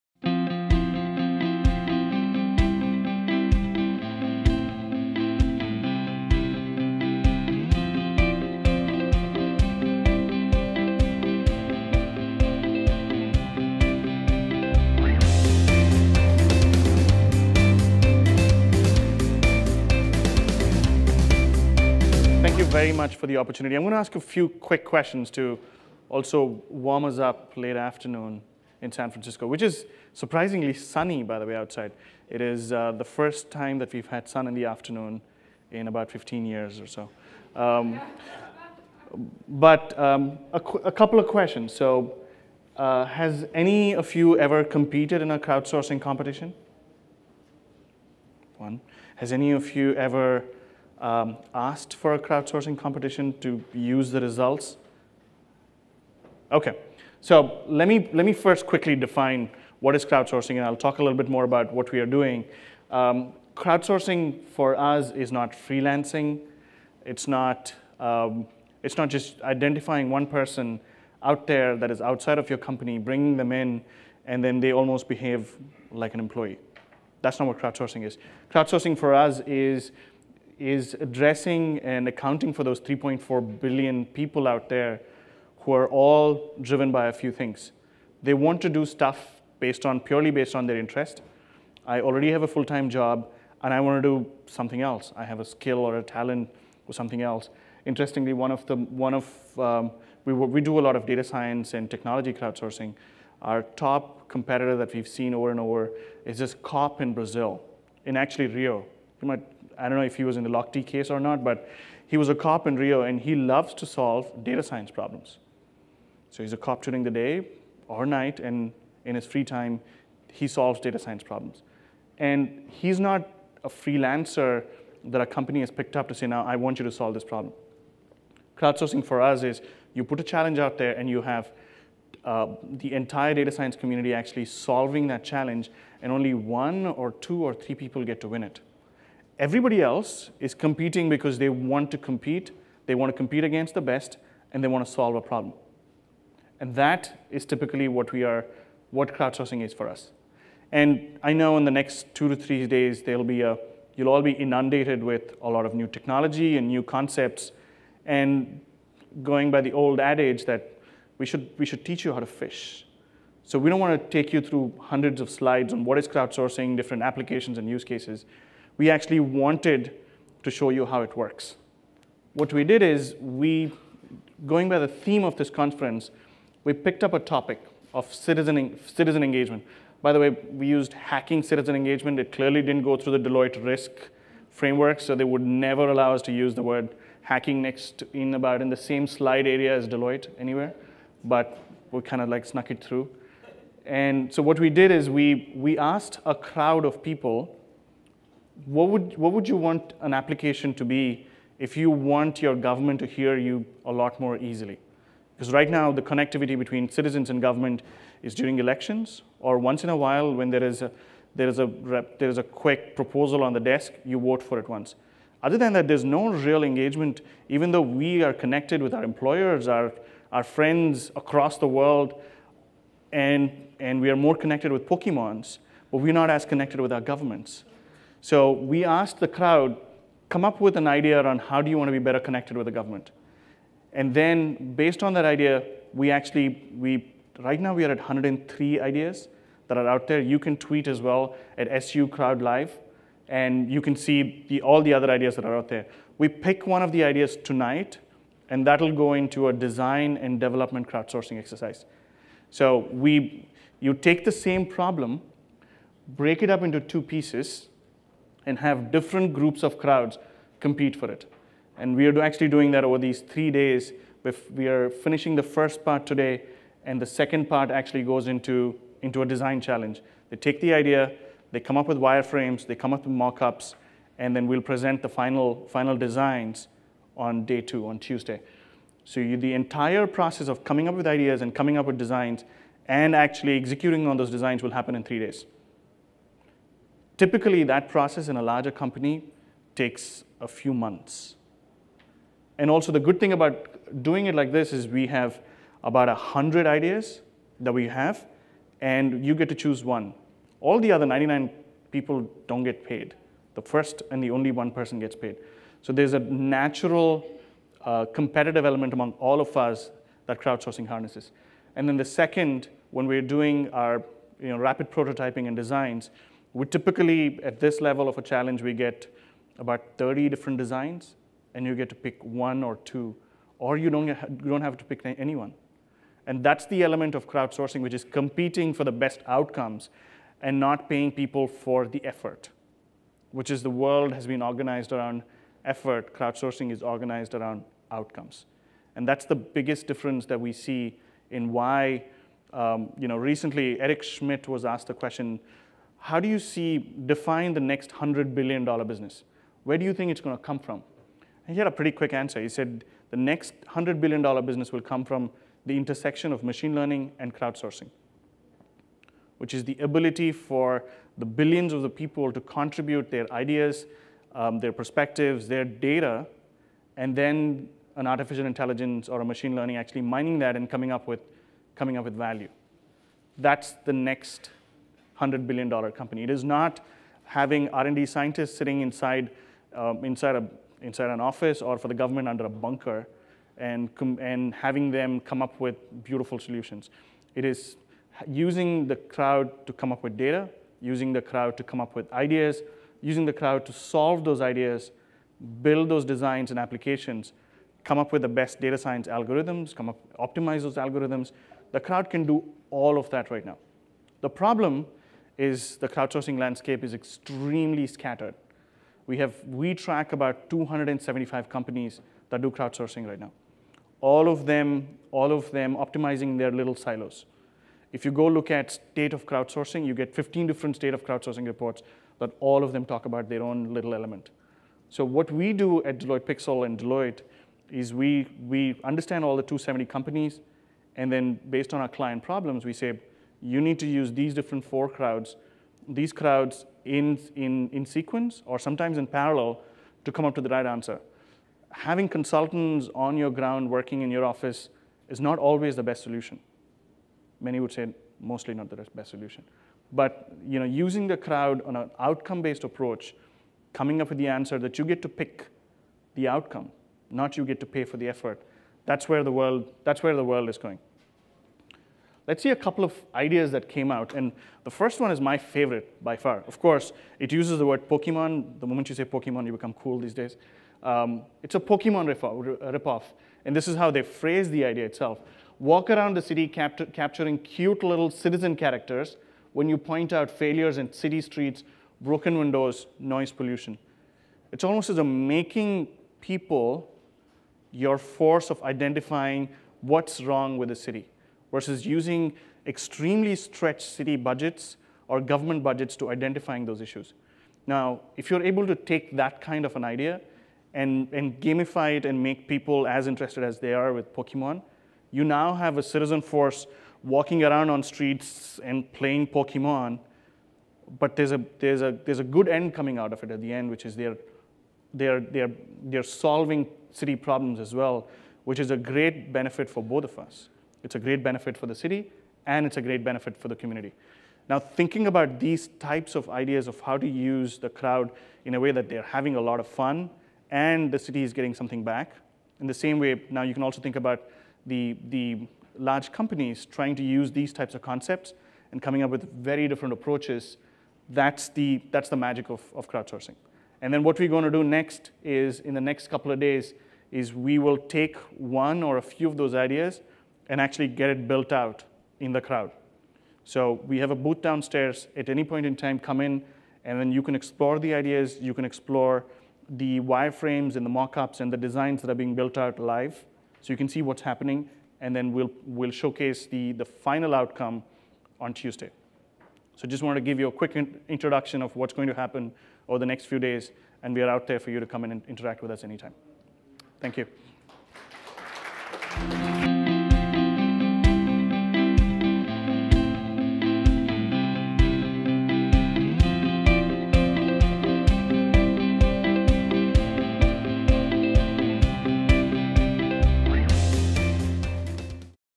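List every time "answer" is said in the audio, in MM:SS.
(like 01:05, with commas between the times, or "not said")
05:52, 07:20, 07:34.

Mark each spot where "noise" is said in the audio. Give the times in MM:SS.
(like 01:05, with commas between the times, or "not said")
08:02.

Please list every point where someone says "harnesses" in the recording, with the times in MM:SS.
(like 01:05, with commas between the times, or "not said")
05:10.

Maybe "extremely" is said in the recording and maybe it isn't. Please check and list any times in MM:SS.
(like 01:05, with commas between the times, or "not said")
06:46, 08:12.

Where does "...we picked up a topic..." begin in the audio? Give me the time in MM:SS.
02:56.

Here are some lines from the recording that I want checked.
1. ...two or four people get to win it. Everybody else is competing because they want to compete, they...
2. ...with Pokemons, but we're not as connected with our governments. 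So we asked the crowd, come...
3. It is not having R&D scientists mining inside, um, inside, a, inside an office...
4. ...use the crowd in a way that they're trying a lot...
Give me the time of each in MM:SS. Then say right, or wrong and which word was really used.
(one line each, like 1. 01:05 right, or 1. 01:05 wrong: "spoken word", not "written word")
1. 02:17 wrong: "three", not "four"
2. 03:44 right
3. 06:16 wrong: "sitting", not "mining"
4. 08:47 wrong: "having", not "trying".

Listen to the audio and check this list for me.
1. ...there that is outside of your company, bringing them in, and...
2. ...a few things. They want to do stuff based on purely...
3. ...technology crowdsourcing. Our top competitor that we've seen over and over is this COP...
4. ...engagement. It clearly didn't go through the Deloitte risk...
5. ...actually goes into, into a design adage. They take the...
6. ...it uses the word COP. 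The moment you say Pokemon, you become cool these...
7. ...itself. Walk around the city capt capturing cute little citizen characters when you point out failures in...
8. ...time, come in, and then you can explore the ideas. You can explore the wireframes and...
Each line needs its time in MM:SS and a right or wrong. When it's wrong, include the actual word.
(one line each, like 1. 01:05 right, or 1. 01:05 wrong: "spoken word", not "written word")
1. 01:11 right
2. 01:27 right
3. 01:41 right
4. 03:01 right
5. 04:27 wrong: "challenge", not "adage"
6. 07:47 wrong: "Pokemon", not "COP"
7. 07:54 right
8. 09:15 right.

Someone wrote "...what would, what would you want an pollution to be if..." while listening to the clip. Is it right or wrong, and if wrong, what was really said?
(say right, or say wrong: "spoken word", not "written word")
wrong: "application", not "pollution".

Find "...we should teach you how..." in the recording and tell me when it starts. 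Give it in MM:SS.
02:41.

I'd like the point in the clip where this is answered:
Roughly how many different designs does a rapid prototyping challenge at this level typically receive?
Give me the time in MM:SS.
05:19.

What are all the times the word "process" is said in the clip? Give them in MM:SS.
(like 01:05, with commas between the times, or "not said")
04:40, 04:47.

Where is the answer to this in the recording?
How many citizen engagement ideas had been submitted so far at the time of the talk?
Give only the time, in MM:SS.
03:57.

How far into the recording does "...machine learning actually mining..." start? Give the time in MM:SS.
06:09.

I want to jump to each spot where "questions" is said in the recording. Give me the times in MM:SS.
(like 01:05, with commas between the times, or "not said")
00:24, 00:41, 05:44.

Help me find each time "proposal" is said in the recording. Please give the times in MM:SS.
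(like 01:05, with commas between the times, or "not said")
03:32.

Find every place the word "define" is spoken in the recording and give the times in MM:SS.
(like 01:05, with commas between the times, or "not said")
00:58, 05:47.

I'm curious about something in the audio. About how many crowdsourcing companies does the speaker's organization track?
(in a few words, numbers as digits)
275.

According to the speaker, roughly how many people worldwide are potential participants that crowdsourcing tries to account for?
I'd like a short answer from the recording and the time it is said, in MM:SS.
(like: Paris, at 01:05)
3.4 billion, at 01:22.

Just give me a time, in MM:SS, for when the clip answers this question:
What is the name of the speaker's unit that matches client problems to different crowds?
07:05.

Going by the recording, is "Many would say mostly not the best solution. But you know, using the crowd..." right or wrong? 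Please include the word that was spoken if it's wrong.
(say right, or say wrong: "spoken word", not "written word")
right.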